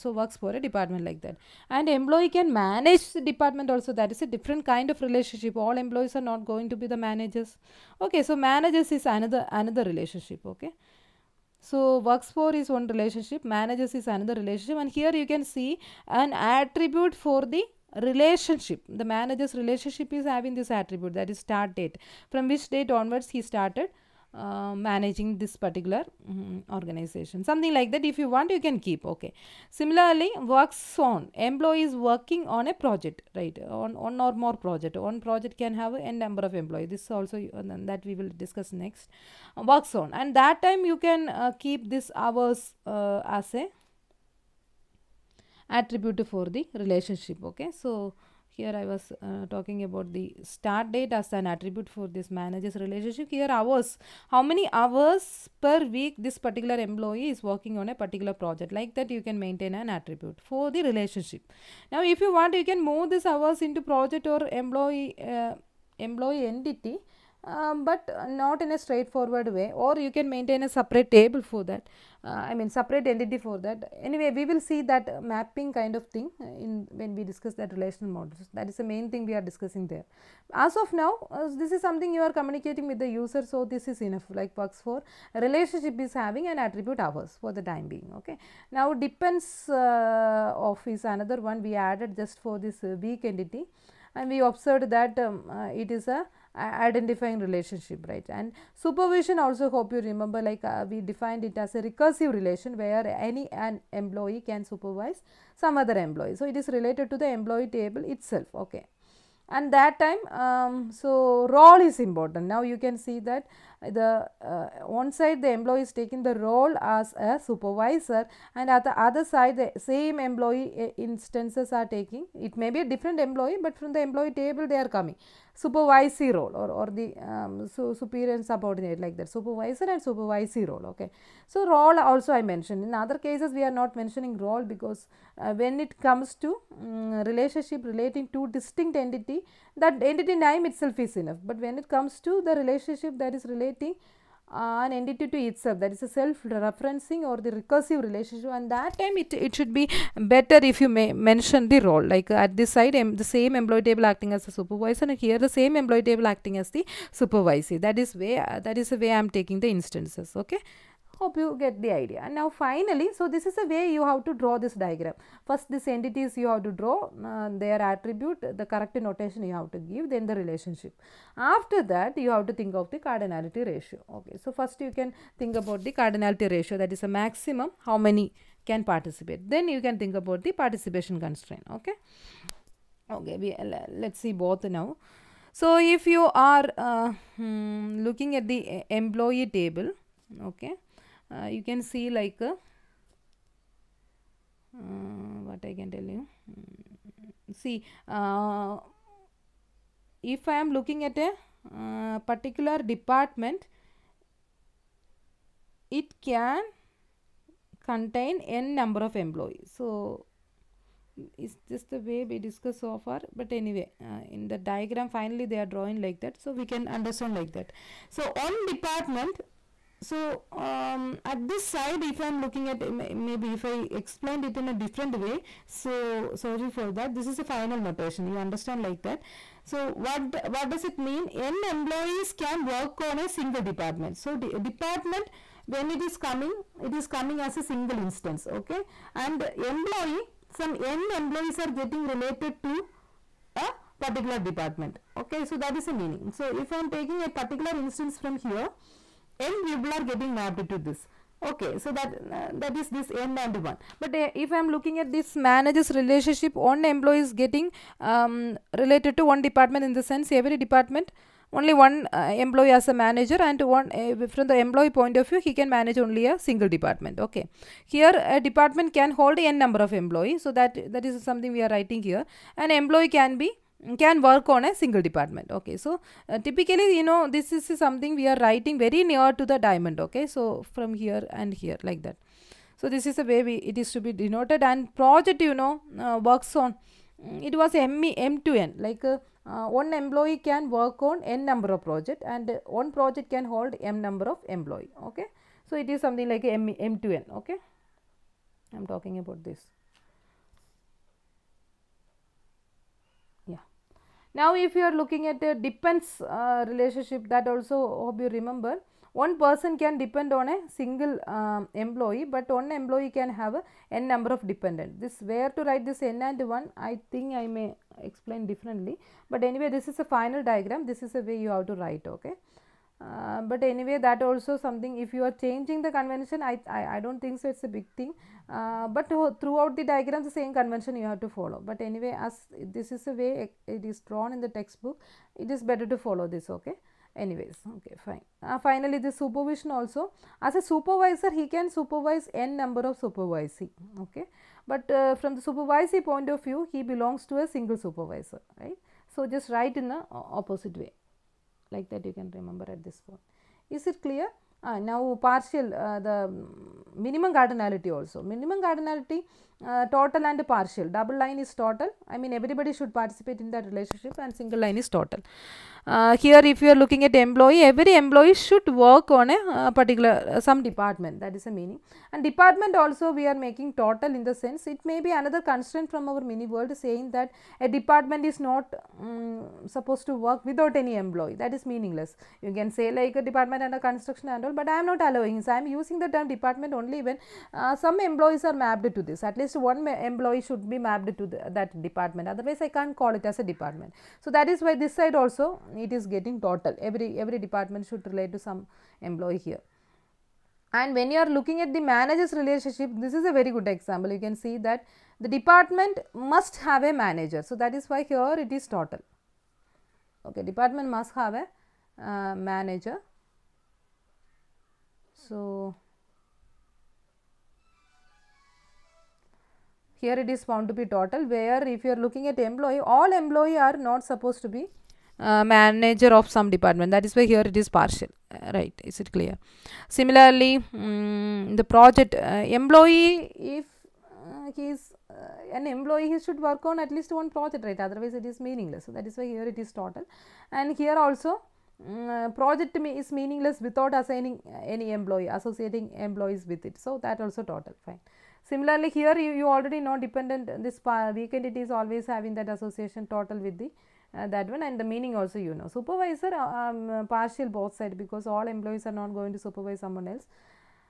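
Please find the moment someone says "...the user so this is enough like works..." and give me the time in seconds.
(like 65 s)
82 s.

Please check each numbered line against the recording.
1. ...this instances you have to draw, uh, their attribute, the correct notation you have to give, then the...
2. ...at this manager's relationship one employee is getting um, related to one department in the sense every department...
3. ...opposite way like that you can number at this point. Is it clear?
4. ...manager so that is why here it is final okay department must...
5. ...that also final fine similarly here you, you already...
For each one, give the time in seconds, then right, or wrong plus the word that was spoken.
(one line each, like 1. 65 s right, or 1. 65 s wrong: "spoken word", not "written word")
1. 165 s wrong: "entities", not "instances"
2. 255 s right
3. 350 s wrong: "remember", not "number"
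4. 406 s wrong: "total", not "final"
5. 447 s wrong: "total", not "final".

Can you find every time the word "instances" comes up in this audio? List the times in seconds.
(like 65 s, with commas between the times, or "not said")
120 s, 159 s, 237 s, 247 s.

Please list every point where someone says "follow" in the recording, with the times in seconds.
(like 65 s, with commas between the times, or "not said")
331 s, 335 s.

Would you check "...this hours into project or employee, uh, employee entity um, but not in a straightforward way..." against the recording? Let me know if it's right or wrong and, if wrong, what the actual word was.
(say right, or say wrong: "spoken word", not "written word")
right.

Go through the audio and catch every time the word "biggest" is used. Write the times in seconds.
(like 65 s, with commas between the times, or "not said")
not said.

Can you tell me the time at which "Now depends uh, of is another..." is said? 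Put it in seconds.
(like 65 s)
88 s.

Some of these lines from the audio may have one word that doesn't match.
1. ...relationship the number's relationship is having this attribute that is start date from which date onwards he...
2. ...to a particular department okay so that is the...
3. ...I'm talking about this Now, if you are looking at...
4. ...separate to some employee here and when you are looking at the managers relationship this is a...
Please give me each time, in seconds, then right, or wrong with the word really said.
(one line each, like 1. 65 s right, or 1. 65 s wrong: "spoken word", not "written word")
1. 18 s wrong: "manager", not "number"
2. 242 s right
3. 298 s right
4. 398 s wrong: "relate", not "separate".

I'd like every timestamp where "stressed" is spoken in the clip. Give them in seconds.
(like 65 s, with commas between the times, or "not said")
not said.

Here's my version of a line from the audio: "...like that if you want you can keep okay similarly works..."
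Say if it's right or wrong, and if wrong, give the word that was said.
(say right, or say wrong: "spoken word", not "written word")
right.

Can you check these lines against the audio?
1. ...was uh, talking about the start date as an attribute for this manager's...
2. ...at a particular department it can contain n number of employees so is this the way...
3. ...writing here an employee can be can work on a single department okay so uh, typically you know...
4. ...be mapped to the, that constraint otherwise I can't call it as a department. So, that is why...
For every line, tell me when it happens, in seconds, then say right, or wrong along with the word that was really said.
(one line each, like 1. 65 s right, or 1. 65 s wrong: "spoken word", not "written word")
1. 48 s right
2. 201 s right
3. 271 s right
4. 390 s wrong: "department", not "constraint".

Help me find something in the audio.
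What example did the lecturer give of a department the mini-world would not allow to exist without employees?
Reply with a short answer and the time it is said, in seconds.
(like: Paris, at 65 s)
department under construction, at 383 s.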